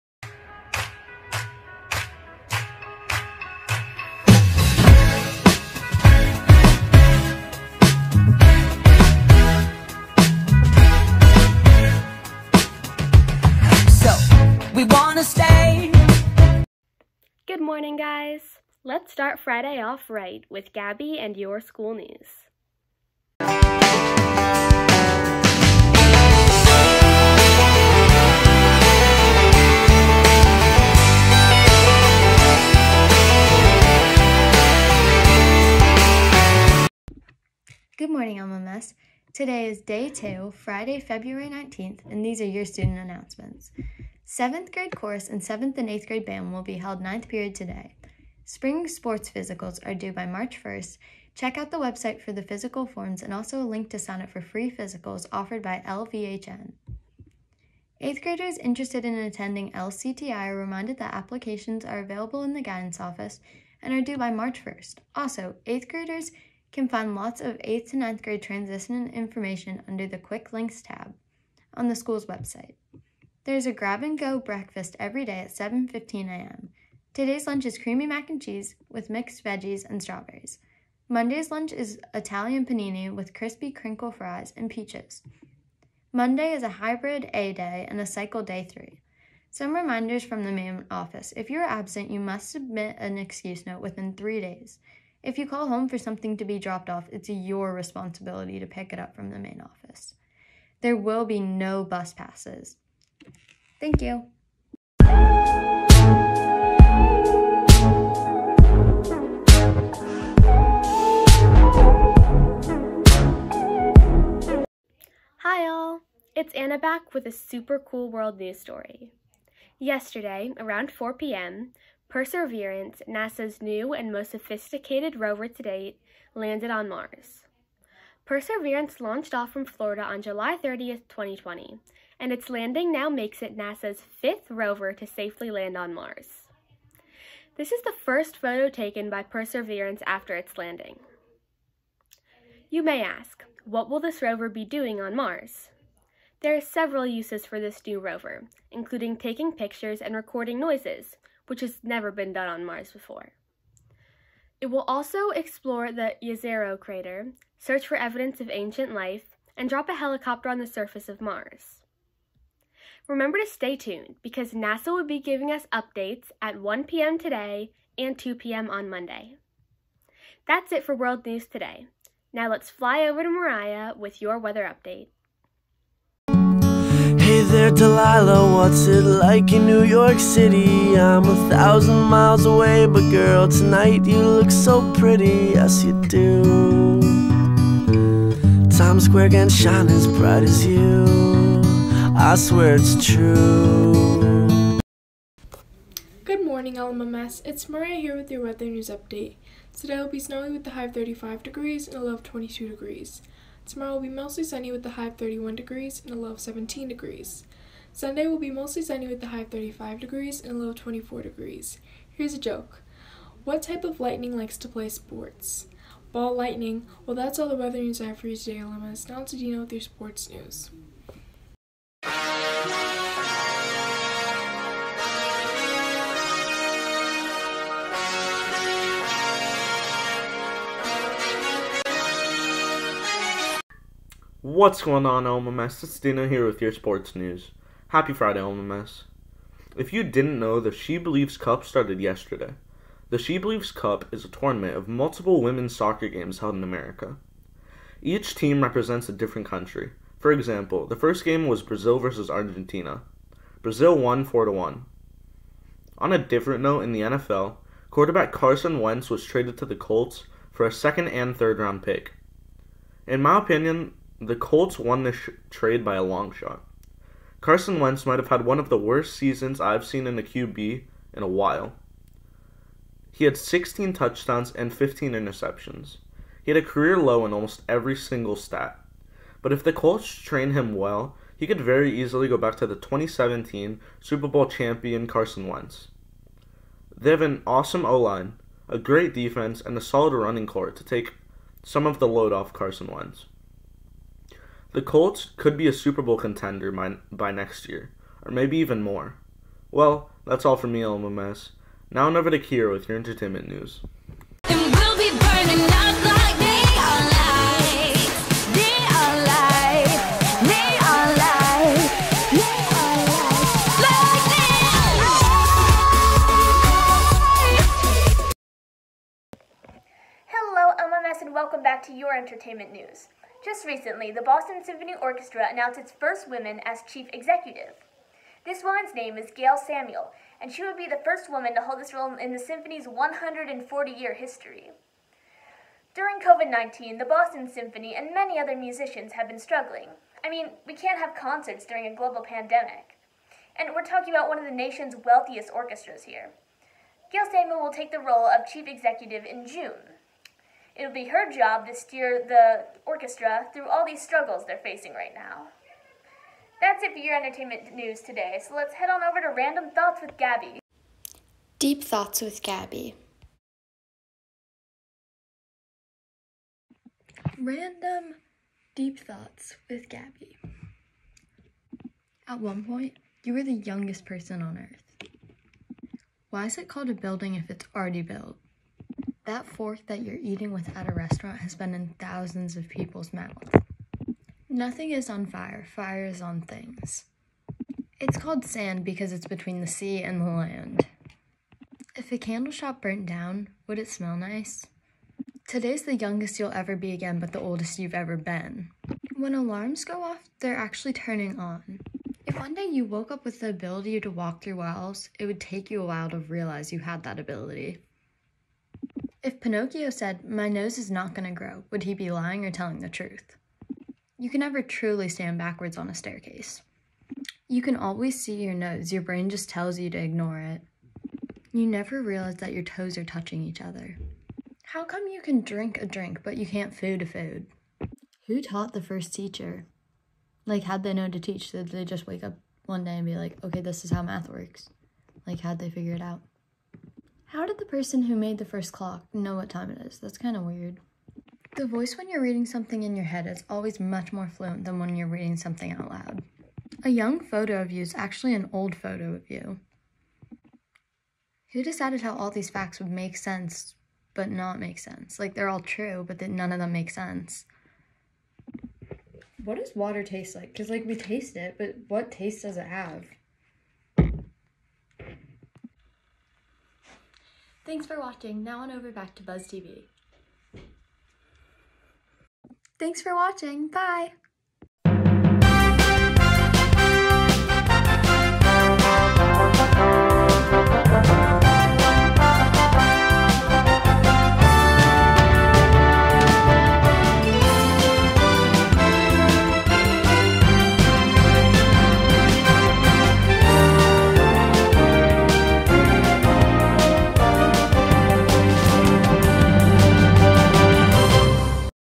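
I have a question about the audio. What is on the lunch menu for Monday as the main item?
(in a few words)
Italian panini.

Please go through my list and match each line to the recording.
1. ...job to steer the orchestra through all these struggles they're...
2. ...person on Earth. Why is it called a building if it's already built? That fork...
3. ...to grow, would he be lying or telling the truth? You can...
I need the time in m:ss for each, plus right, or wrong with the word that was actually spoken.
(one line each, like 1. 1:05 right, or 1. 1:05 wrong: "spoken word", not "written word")
1. 5:51 right
2. 6:14 right
3. 6:51 right.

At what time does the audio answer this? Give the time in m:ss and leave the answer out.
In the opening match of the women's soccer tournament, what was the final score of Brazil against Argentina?
4:14.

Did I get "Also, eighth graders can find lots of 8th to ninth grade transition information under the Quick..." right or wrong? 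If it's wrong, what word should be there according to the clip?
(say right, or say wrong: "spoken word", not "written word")
right.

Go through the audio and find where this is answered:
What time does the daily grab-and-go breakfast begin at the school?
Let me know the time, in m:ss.
1:15.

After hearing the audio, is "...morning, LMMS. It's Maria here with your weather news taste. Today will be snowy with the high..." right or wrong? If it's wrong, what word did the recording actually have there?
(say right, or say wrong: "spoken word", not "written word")
wrong: "update", not "taste".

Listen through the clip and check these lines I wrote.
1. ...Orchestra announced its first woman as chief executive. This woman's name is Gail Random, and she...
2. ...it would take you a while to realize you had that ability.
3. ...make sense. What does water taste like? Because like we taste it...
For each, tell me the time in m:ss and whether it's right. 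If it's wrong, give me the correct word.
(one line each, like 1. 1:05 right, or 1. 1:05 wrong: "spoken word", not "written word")
1. 5:25 wrong: "Samuel", not "Random"
2. 6:45 right
3. 7:36 right.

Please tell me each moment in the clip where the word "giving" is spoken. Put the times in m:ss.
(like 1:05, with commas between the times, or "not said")
2:45.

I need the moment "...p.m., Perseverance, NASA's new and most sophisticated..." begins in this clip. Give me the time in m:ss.
2:01.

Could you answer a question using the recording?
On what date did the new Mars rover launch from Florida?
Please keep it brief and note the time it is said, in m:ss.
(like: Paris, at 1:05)
July 30th, 2020, at 2:10.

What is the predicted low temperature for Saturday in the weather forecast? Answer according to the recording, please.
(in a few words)
17 degrees.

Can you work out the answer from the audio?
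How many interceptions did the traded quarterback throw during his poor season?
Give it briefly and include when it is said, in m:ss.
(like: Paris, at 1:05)
15, at 4:34.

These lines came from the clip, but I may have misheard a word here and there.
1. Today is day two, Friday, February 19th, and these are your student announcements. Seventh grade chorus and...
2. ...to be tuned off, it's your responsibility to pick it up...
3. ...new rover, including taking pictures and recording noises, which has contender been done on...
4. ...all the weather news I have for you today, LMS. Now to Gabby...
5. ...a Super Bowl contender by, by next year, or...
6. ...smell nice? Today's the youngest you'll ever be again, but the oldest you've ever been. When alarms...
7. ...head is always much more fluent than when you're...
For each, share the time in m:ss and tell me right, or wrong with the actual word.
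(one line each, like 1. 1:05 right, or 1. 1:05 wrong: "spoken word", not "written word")
1. 0:39 right
2. 1:36 wrong: "dropped", not "tuned"
3. 2:27 wrong: "never", not "contender"
4. 3:37 wrong: "Dino", not "Gabby"
5. 4:55 right
6. 6:33 right
7. 7:23 right.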